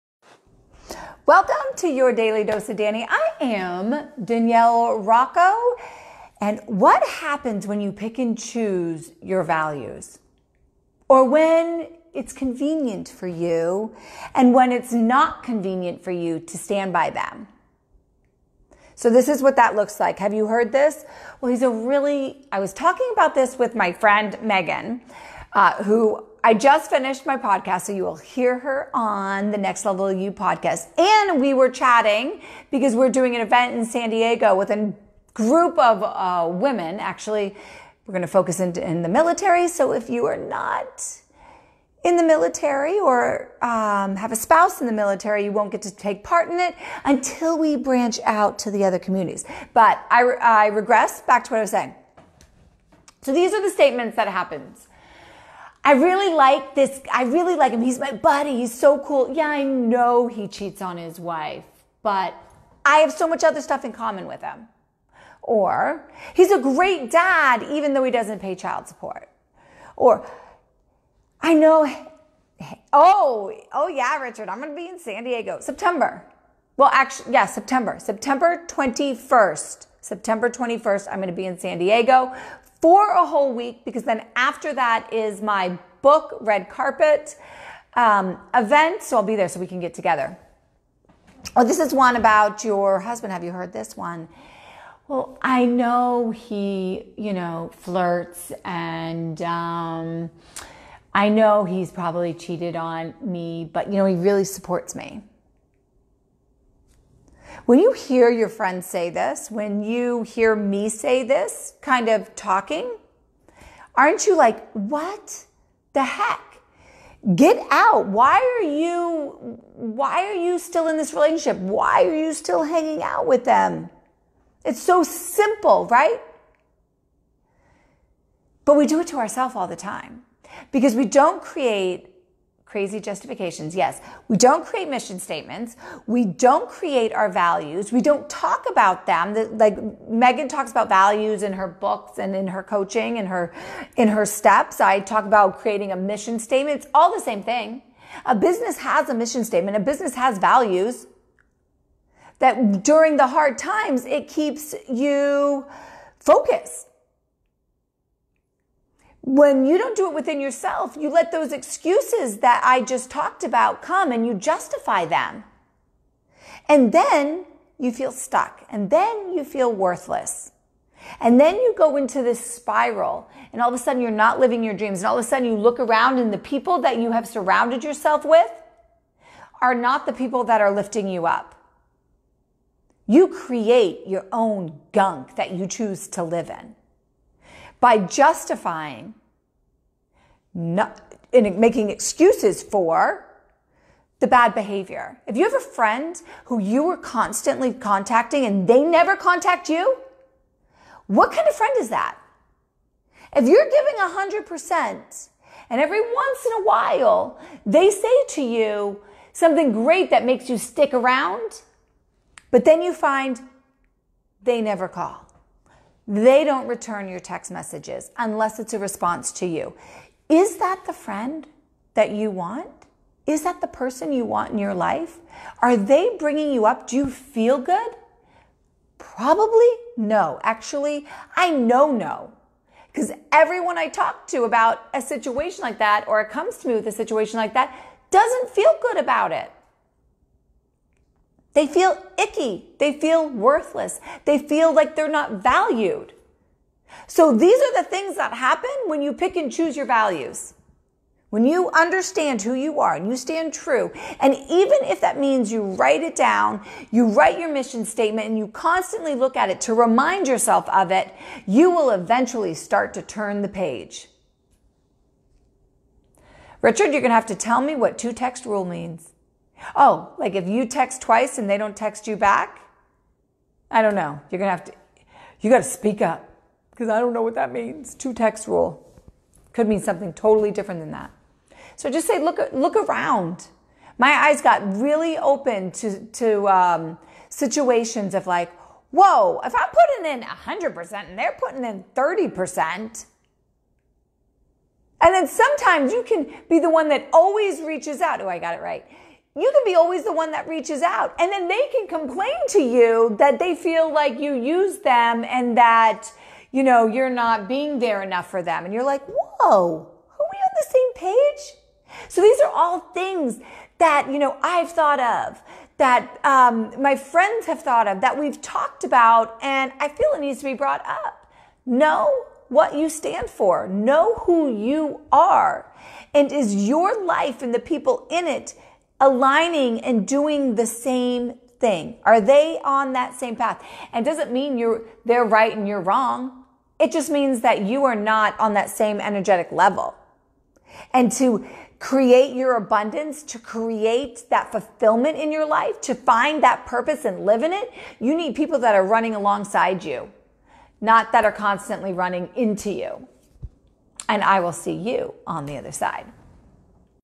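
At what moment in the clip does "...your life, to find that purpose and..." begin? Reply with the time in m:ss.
5:45.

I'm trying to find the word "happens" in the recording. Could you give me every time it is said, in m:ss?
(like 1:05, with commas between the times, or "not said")
0:07, 0:54, 4:08.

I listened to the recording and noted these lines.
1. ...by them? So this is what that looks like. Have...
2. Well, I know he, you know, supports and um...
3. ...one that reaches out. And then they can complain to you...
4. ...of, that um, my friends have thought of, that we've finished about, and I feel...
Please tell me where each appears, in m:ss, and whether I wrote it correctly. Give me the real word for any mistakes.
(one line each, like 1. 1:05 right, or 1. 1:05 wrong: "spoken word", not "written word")
1. 0:16 right
2. 1:35 wrong: "flirts", not "supports"
3. 5:00 right
4. 5:14 wrong: "talked", not "finished".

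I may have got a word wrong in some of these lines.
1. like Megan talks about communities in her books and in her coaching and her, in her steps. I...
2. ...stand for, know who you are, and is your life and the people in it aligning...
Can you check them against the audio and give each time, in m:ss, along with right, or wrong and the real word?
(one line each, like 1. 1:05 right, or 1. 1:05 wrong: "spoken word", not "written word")
1. 2:19 wrong: "values", not "communities"
2. 5:22 right.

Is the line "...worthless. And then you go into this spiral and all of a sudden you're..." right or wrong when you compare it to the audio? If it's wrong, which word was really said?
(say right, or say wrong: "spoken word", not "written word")
right.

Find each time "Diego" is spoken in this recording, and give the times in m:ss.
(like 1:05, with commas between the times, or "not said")
0:34, 1:15, 1:21.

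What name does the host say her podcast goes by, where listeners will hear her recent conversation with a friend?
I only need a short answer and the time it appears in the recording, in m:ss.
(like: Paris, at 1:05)
Next Level You, at 0:29.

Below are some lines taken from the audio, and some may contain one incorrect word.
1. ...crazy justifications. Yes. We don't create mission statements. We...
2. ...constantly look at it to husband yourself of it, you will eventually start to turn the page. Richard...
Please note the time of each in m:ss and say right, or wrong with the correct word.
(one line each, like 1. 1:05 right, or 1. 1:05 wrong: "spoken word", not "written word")
1. 2:12 right
2. 4:18 wrong: "remind", not "husband".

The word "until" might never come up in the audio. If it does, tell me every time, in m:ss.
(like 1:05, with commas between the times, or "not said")
0:47.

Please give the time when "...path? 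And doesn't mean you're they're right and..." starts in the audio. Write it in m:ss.
5:33.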